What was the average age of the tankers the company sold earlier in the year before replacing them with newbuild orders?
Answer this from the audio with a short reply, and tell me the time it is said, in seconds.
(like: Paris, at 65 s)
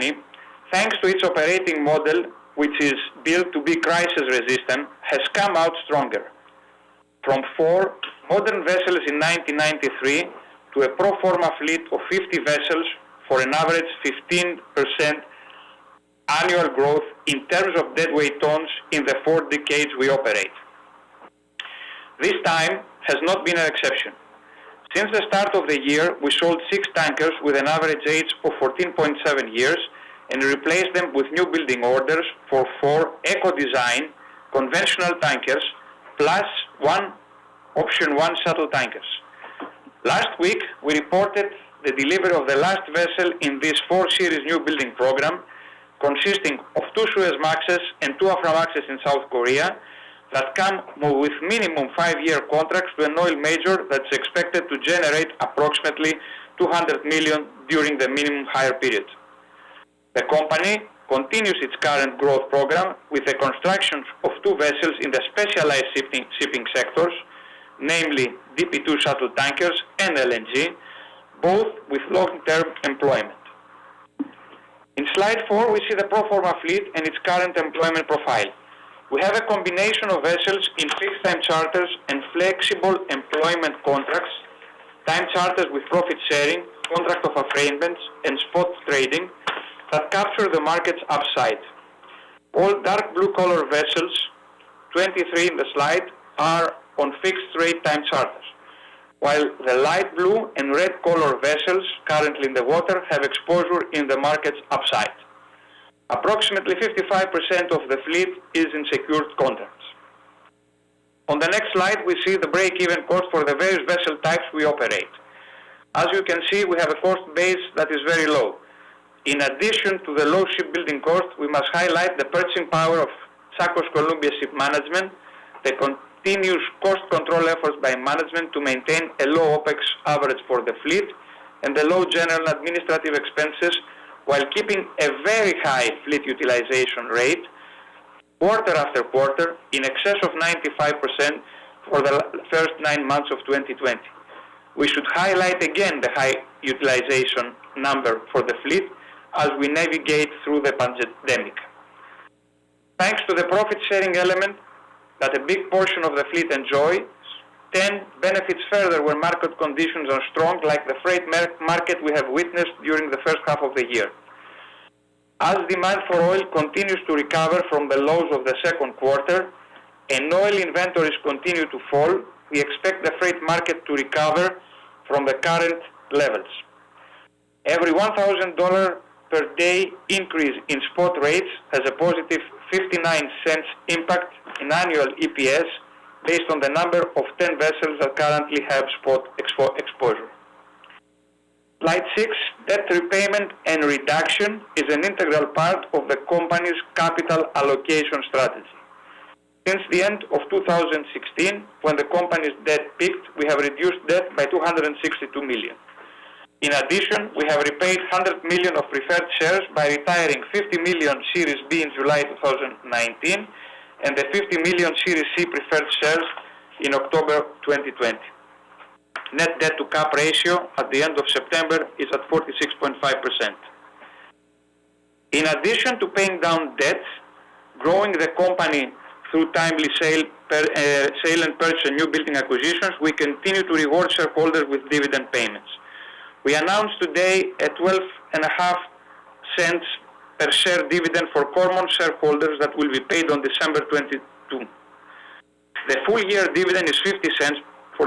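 14.7 years, at 28 s.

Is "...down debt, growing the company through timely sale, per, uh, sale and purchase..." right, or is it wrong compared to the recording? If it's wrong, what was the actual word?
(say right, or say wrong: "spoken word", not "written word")
right.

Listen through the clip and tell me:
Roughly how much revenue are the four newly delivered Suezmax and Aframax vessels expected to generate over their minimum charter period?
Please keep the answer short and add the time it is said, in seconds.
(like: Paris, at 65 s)
200 million, at 56 s.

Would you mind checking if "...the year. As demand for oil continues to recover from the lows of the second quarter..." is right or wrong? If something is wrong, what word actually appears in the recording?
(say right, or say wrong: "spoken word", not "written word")
right.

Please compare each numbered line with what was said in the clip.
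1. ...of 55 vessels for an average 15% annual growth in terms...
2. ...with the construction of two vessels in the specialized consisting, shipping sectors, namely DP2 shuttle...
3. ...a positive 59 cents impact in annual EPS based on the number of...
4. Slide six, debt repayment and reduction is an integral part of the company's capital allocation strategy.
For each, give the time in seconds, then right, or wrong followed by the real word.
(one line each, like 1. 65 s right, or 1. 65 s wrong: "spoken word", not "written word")
1. 11 s wrong: "50", not "55"
2. 63 s wrong: "shipping", not "consisting"
3. 181 s right
4. 191 s right.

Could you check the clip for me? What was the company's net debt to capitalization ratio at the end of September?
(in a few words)
46.5%.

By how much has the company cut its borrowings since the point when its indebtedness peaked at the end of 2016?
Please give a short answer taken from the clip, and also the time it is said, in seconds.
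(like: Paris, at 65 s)
262 million, at 204 s.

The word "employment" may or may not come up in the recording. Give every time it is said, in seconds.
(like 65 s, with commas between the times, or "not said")
72 s, 77 s, 83 s.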